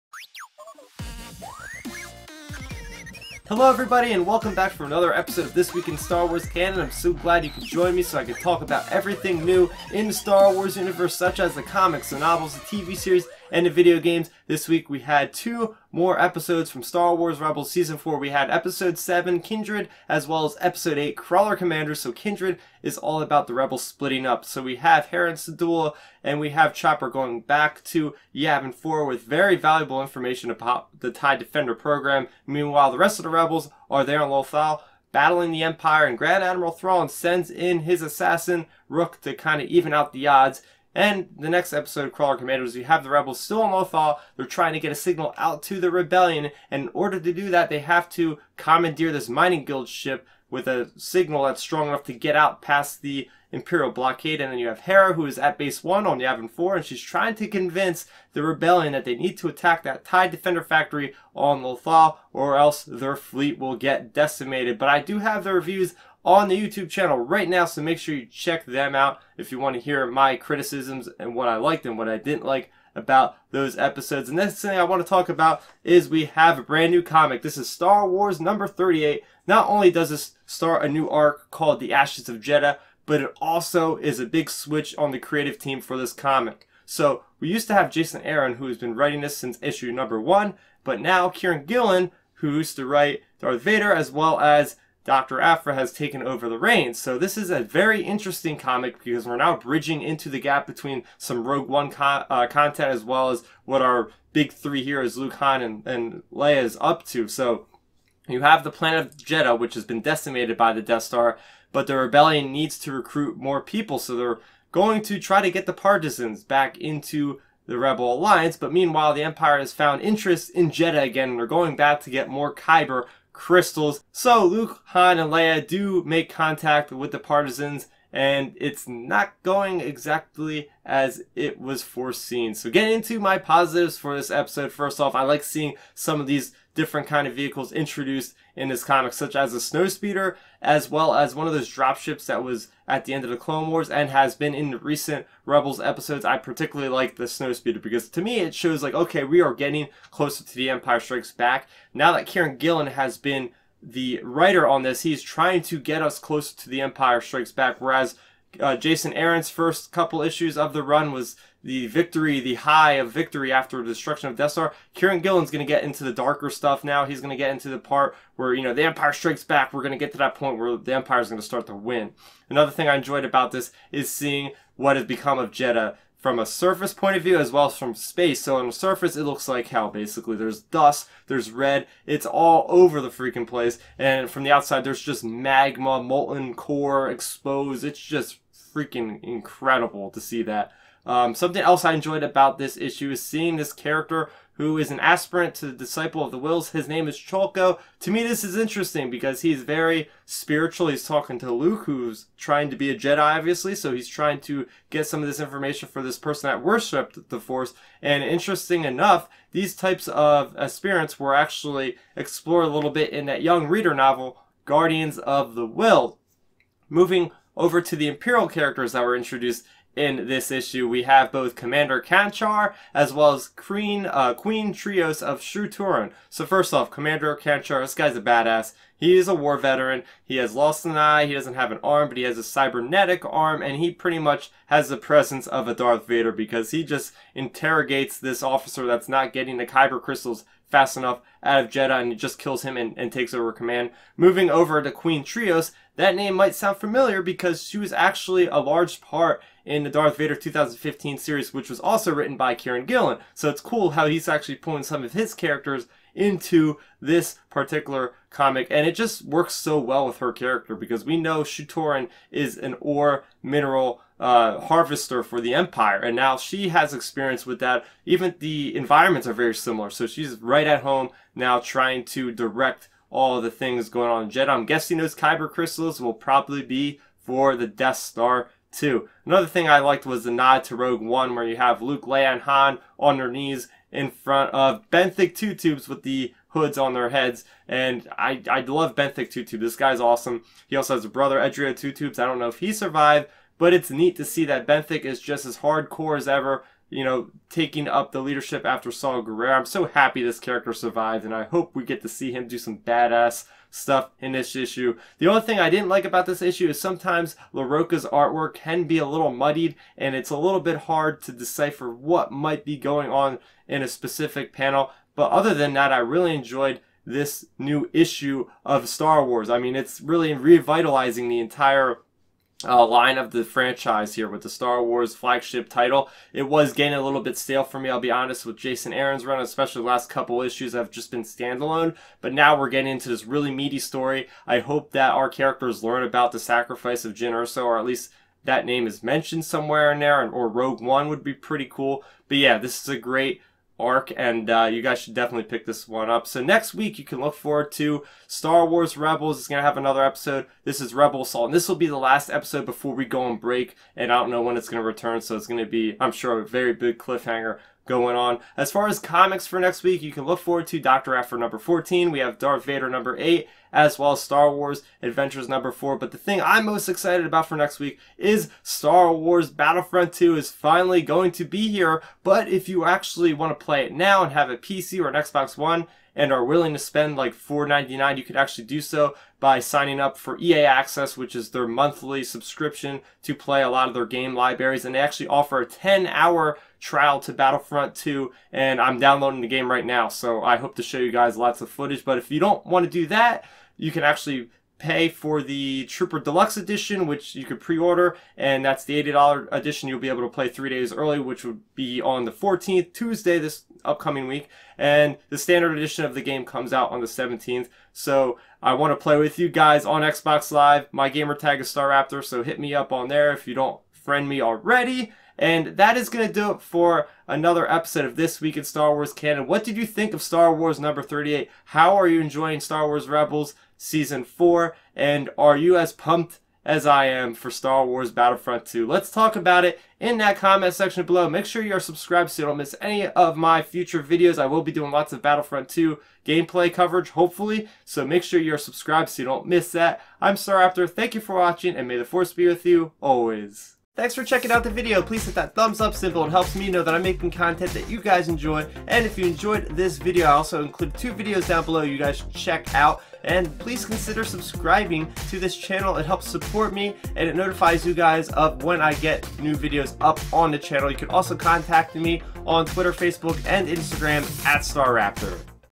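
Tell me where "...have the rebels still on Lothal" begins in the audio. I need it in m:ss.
0:42.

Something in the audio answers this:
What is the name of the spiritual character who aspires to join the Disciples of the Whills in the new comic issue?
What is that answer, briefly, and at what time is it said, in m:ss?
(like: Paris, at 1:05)
Cholko, at 3:17.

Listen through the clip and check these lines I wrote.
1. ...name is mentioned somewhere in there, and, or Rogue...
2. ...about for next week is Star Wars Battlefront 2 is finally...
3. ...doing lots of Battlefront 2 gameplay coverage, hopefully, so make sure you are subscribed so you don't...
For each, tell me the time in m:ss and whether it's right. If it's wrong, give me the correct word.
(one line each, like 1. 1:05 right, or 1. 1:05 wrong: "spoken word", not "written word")
1. 5:38 right
2. 6:07 right
3. 7:14 right.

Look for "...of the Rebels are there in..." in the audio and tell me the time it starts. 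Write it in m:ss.
0:33.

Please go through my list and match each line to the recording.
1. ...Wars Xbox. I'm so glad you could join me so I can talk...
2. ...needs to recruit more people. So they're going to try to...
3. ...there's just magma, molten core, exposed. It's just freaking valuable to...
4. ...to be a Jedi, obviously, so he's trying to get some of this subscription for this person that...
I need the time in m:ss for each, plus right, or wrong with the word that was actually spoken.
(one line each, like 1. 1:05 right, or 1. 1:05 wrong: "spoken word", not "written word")
1. 0:06 wrong: "Canon", not "Xbox"
2. 1:52 right
3. 3:04 wrong: "incredible", not "valuable"
4. 3:22 wrong: "information", not "subscription".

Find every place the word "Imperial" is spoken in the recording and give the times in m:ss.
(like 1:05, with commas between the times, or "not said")
0:53, 3:38.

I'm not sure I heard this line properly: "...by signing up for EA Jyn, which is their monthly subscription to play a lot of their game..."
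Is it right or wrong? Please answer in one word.
wrong.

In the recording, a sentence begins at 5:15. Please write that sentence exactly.
But other than that, I really enjoyed this new issue of Star Wars.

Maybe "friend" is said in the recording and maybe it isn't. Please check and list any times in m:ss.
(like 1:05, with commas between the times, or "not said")
6:53.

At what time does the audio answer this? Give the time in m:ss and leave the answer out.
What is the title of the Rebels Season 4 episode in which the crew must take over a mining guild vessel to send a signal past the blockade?
0:21.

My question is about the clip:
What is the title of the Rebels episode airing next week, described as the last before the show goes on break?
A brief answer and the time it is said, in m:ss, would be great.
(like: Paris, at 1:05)
Rebel Assault, at 5:50.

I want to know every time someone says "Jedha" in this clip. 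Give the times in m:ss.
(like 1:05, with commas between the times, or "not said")
1:22, 1:49, 2:00, 2:55, 4:01, 4:34.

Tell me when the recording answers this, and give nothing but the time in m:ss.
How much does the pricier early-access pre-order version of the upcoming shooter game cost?
6:39.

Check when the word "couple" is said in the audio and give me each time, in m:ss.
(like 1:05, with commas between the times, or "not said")
2:39, 5:30.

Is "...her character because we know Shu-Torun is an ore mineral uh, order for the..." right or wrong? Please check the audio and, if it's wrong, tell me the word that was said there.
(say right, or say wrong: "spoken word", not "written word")
wrong: "harvester", not "order".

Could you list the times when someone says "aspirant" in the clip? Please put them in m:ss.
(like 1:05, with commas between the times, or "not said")
3:14, 3:30.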